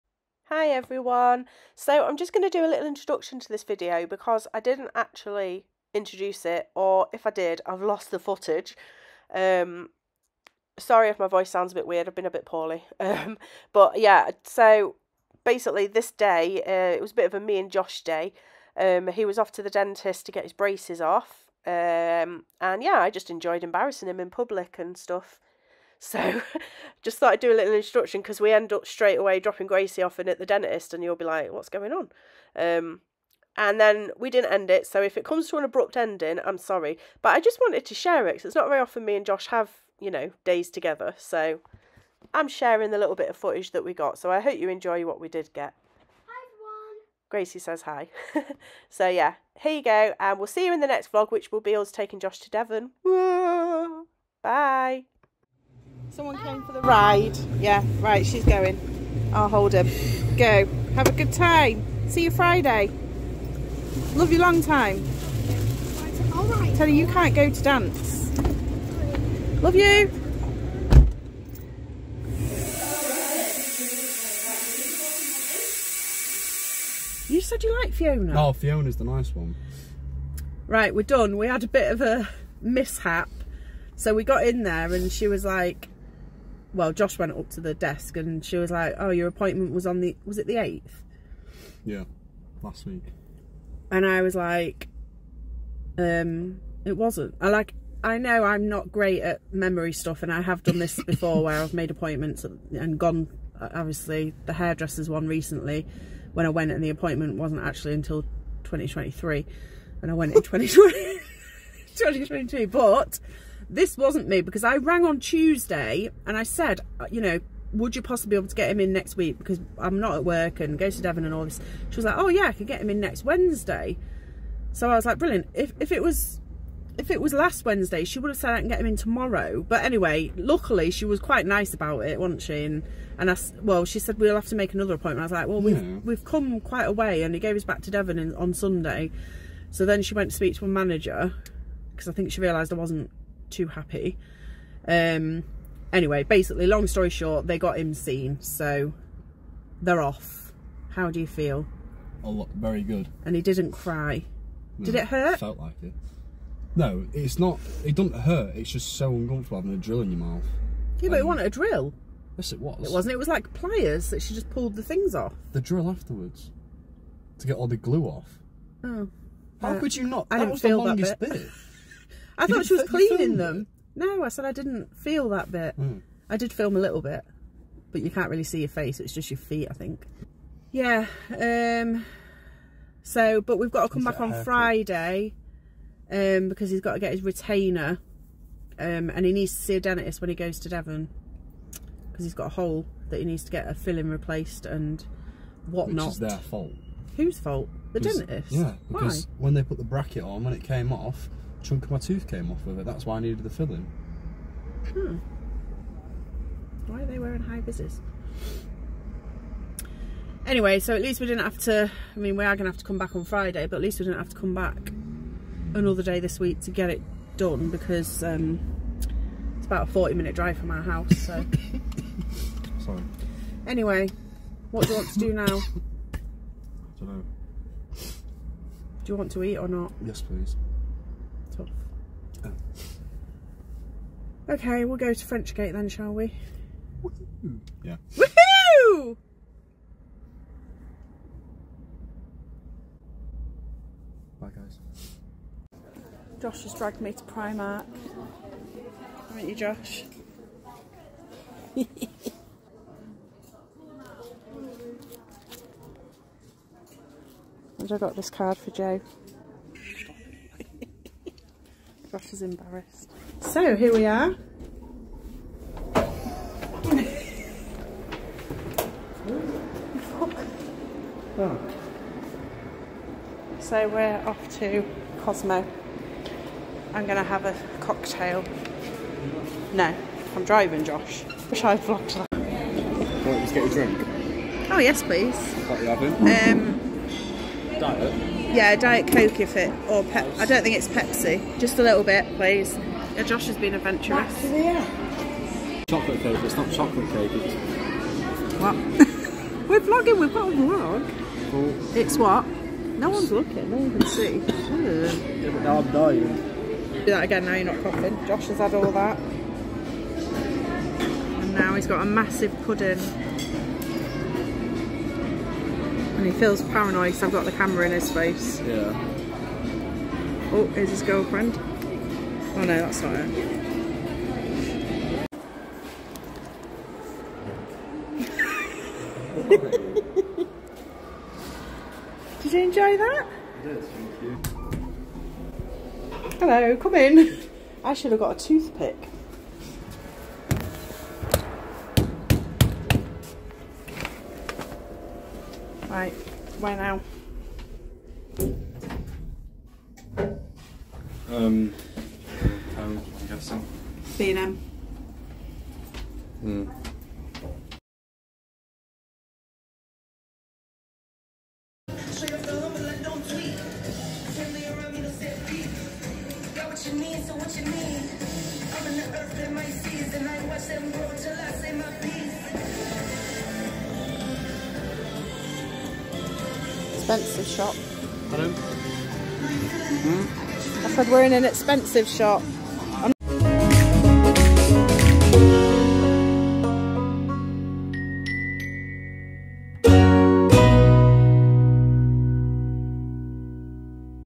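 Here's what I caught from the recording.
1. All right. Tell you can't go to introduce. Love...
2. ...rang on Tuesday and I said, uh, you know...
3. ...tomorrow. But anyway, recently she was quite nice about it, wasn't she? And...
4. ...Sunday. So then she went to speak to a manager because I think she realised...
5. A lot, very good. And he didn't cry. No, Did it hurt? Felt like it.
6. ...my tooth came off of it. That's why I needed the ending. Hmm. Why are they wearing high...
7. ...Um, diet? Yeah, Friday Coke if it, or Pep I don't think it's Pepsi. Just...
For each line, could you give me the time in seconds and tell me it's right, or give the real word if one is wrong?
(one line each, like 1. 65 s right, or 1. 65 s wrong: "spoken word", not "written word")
1. 66 s wrong: "dance", not "introduce"
2. 114 s right
3. 128 s wrong: "luckily", not "recently"
4. 138 s right
5. 152 s right
6. 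201 s wrong: "filling", not "ending"
7. 285 s wrong: "Diet", not "Friday".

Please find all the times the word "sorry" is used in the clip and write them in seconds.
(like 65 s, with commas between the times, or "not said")
10 s, 36 s, 222 s.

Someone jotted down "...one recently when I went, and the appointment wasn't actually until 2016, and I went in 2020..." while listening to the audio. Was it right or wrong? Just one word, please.
wrong.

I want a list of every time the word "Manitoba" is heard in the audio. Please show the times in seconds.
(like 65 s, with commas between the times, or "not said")
not said.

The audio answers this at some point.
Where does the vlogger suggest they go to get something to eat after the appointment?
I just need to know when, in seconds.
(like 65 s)
235 s.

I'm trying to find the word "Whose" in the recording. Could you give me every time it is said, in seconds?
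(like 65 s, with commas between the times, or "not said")
197 s.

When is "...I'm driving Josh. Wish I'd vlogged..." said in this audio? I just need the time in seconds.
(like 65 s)
280 s.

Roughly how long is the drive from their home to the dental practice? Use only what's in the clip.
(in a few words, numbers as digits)
40 minutes.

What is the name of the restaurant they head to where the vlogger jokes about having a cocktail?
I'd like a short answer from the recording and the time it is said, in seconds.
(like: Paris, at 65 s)
Cosmo, at 275 s.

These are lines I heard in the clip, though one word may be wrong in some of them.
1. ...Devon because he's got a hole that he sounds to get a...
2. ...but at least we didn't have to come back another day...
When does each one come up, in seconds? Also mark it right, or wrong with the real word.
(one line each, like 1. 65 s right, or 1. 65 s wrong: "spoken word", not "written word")
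1. 190 s wrong: "needs", not "sounds"
2. 213 s right.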